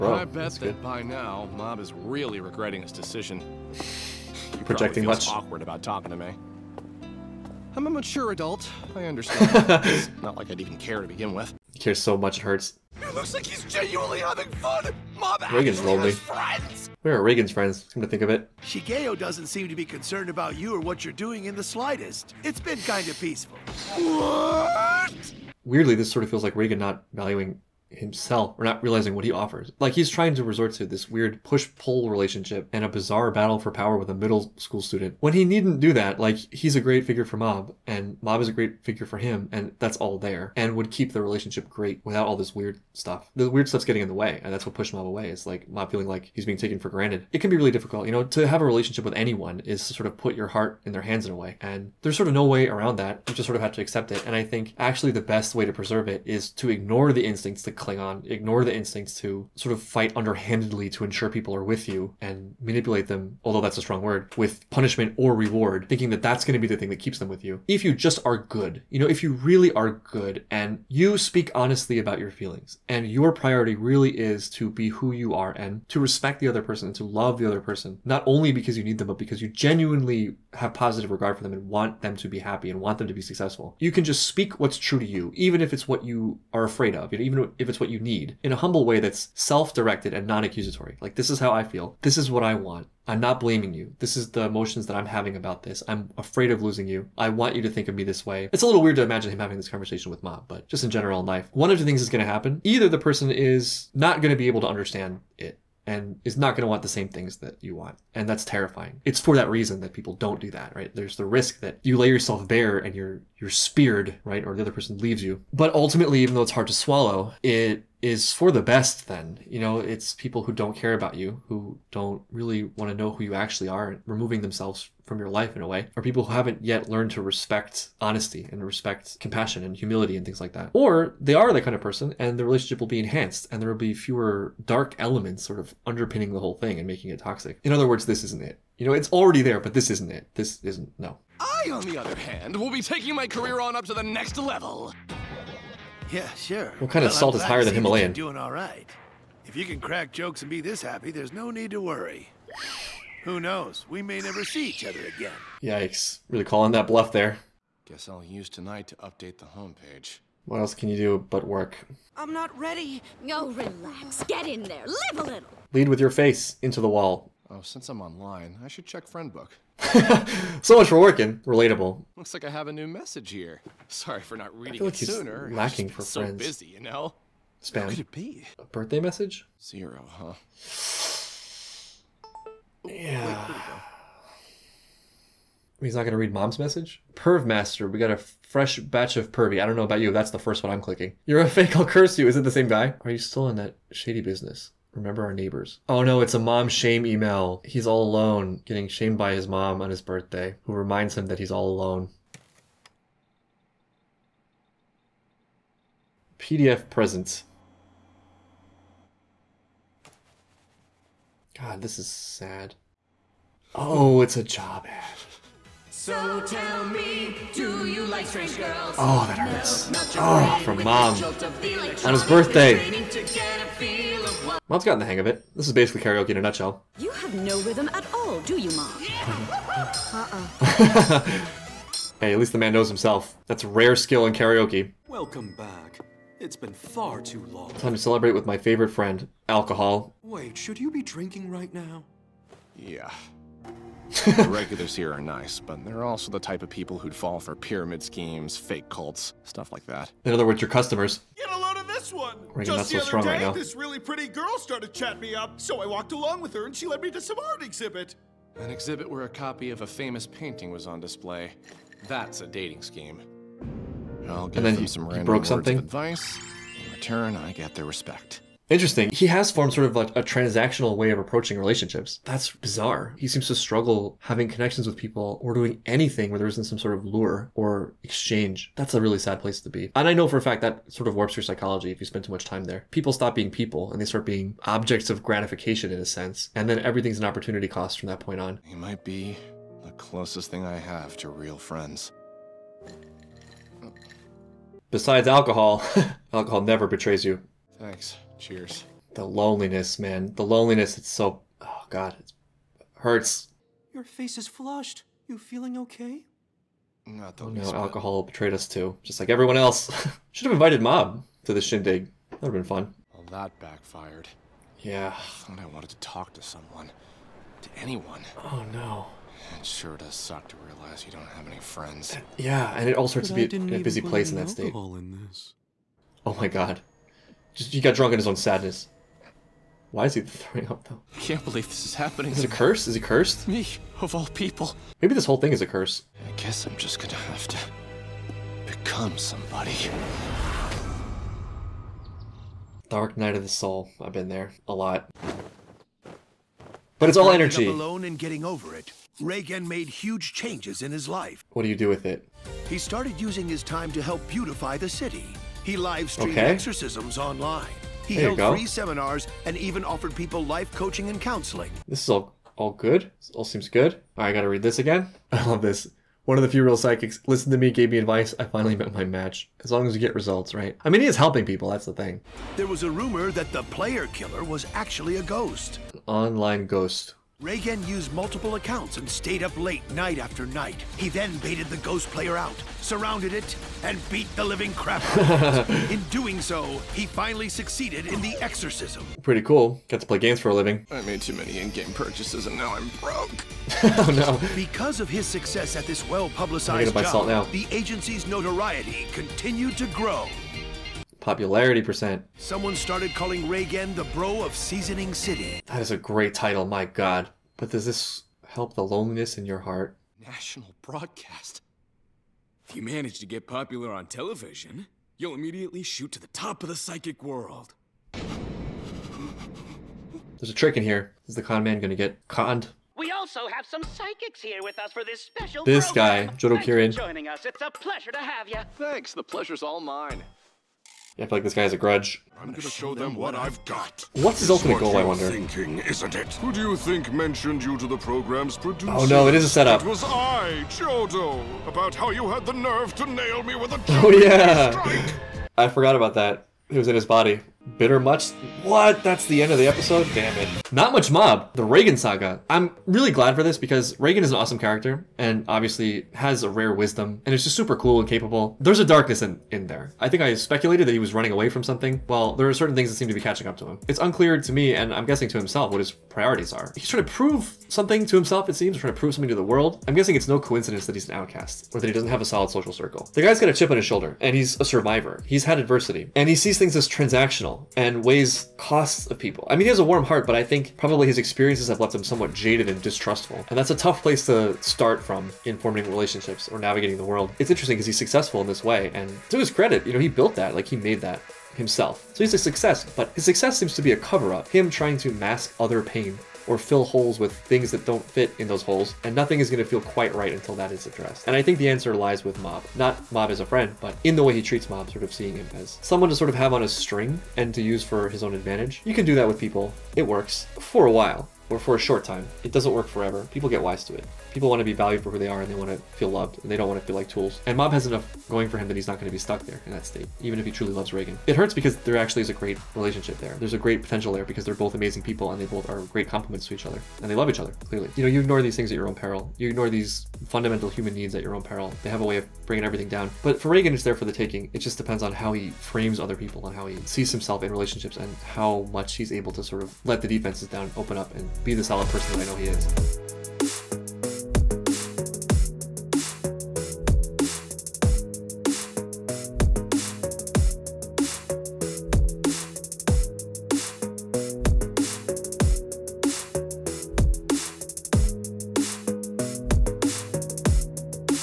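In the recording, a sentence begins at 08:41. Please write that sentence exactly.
It hurts because there actually is a great relationship there.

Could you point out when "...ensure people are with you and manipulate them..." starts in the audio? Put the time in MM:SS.
01:01.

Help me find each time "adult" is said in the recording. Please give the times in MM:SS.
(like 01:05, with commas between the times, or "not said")
00:08.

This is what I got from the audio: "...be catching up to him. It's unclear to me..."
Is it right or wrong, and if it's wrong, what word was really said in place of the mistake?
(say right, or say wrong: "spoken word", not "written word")
right.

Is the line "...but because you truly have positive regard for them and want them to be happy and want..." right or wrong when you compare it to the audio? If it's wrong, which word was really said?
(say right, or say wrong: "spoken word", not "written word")
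wrong: "genuinely", not "truly".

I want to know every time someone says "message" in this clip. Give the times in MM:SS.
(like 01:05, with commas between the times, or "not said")
02:52, 02:59, 03:06.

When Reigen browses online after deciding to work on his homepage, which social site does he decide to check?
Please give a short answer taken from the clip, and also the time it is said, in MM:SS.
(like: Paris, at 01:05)
Friend Book, at 02:49.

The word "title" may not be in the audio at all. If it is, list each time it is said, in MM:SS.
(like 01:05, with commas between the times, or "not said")
06:46.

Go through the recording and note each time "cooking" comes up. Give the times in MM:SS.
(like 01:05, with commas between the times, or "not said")
not said.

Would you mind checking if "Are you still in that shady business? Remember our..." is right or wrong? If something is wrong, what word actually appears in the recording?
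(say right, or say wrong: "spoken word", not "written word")
right.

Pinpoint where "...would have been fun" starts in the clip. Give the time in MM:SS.
05:12.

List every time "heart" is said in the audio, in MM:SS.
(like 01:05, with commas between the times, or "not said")
00:50, 06:49, 08:00.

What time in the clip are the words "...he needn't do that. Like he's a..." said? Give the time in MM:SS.
00:35.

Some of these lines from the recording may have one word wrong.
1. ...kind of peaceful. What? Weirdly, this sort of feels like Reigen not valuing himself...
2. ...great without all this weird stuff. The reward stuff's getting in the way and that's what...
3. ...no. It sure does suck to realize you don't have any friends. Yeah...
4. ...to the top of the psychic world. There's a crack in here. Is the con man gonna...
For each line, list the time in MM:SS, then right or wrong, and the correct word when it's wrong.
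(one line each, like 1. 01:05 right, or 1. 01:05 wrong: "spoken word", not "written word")
1. 00:22 right
2. 00:41 wrong: "weird", not "reward"
3. 05:18 right
4. 06:56 wrong: "trick", not "crack".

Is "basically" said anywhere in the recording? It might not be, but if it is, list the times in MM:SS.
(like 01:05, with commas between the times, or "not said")
03:45.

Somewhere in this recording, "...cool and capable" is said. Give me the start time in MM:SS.
07:37.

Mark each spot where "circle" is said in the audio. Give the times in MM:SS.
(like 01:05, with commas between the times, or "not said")
07:52.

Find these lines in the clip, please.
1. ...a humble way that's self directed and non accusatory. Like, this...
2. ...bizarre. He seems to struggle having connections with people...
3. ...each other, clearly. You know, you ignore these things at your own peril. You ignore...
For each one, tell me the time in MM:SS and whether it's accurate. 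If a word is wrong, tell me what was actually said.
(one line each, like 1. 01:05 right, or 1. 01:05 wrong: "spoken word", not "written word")
1. 01:28 right
2. 04:32 right
3. 08:47 right.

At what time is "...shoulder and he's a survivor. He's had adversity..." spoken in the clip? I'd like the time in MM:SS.
07:53.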